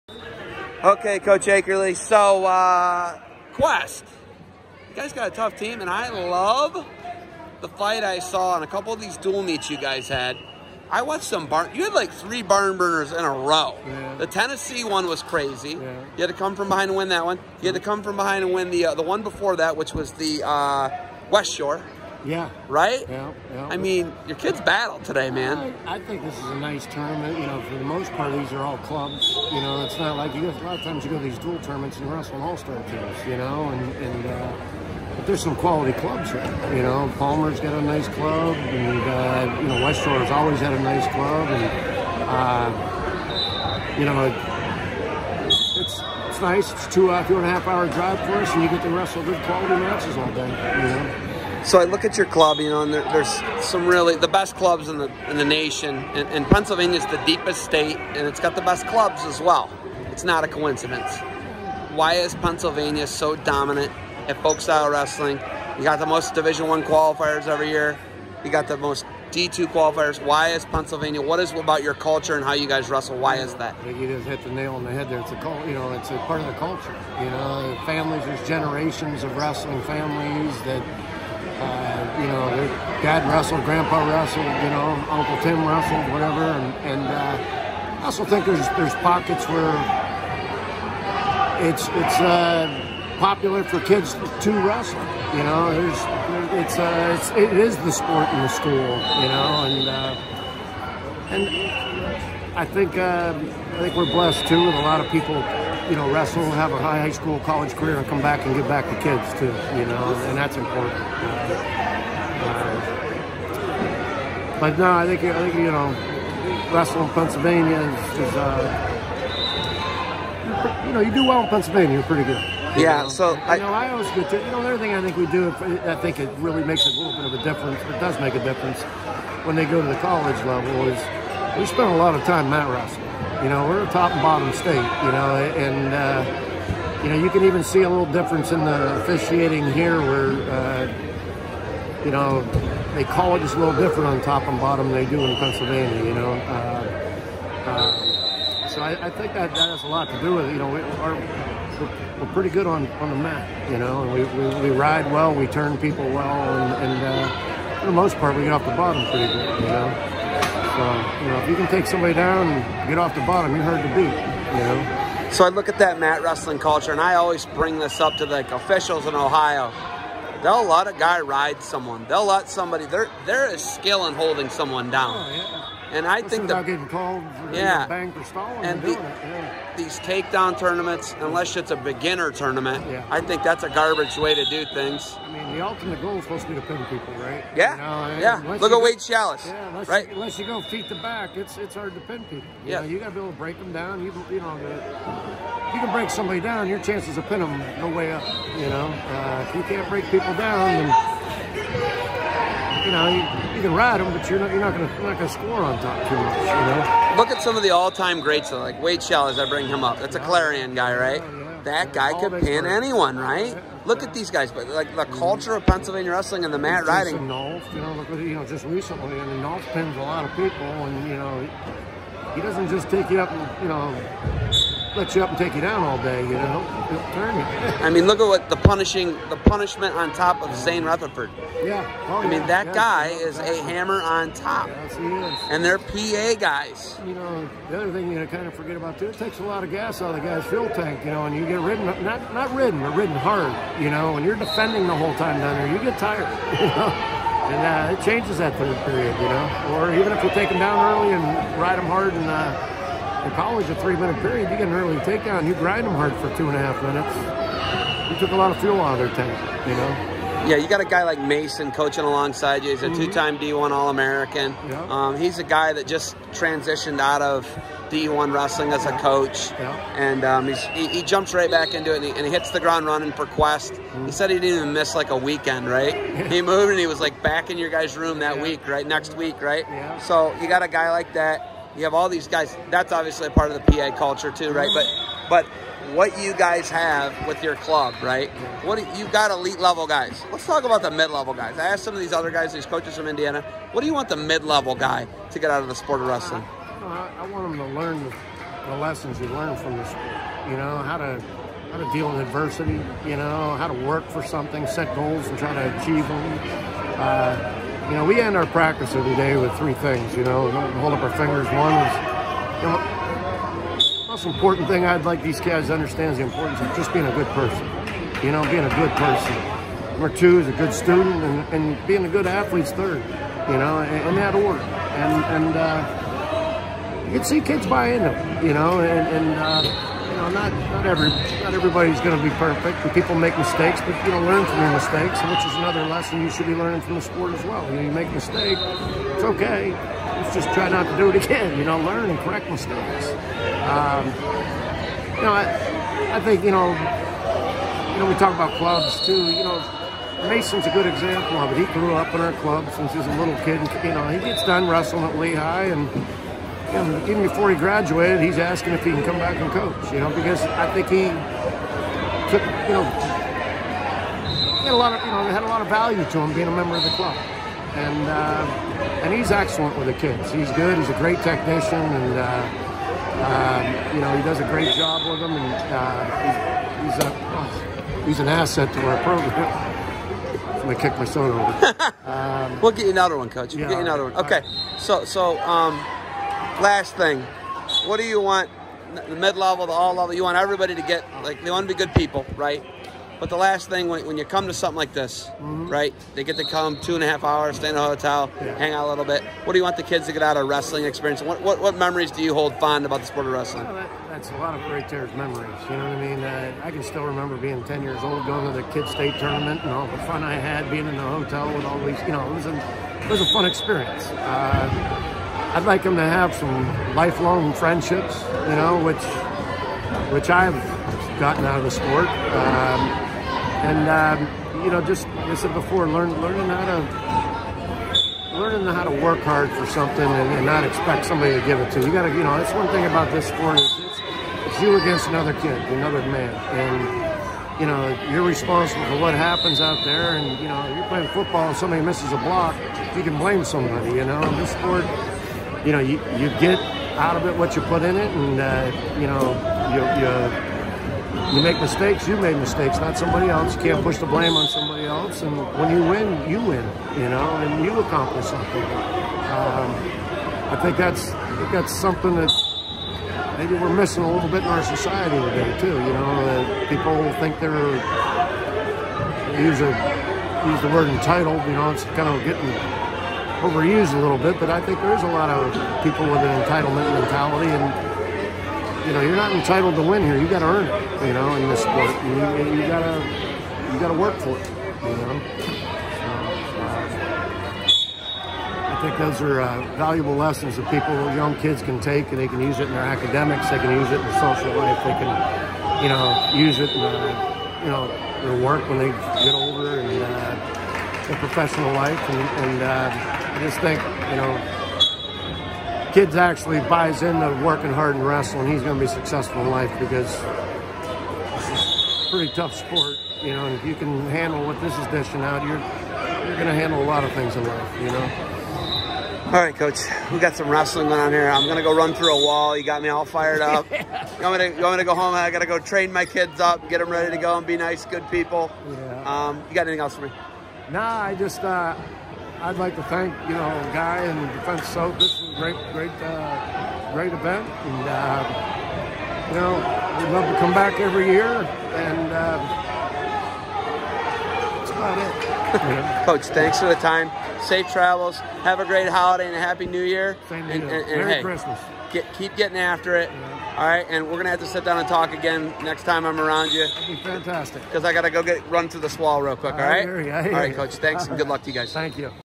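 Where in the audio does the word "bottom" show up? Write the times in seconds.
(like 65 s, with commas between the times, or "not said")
134 s, 144 s, 158 s, 163 s.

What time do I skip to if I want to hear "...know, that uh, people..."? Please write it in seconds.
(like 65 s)
465 s.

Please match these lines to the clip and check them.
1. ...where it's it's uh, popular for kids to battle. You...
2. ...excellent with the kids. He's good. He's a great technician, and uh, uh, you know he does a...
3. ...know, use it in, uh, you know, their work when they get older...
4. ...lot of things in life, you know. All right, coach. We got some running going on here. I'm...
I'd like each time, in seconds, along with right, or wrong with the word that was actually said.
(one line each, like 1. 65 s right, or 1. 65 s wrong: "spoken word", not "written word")
1. 89 s wrong: "wrestle", not "battle"
2. 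369 s right
3. 495 s right
4. 516 s wrong: "wrestling", not "running".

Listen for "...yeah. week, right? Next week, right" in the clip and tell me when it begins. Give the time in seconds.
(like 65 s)
278 s.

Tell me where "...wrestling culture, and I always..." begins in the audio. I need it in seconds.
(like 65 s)
166 s.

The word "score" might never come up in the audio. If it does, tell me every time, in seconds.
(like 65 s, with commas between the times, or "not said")
205 s.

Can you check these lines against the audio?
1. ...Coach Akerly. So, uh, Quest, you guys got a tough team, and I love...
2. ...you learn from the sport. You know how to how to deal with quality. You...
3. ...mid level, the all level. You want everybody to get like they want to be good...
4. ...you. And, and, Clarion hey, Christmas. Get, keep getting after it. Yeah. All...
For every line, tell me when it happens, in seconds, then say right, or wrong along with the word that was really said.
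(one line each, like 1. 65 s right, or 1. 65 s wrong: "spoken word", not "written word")
1. 1 s right
2. 299 s wrong: "adversity", not "quality"
3. 389 s right
4. 550 s wrong: "Merry", not "Clarion".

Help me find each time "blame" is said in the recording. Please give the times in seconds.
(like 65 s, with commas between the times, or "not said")
443 s, 454 s.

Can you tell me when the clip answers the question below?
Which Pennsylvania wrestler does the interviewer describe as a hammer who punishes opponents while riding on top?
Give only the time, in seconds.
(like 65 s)
230 s.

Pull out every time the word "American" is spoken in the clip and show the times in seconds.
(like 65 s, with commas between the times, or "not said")
263 s.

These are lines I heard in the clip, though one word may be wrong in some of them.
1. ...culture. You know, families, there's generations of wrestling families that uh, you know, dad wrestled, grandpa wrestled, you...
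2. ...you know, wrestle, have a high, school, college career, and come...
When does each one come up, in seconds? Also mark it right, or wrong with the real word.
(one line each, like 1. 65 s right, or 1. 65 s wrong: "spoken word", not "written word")
1. 76 s right
2. 105 s right.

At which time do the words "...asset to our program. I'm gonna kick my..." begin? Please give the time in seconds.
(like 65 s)
378 s.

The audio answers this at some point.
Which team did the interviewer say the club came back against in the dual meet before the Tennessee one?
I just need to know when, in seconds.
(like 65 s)
21 s.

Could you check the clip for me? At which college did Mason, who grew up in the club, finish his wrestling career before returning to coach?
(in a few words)
Lehigh.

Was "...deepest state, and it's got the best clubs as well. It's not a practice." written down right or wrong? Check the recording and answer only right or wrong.
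wrong.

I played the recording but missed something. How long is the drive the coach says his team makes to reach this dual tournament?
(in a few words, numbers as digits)
two and a half hours.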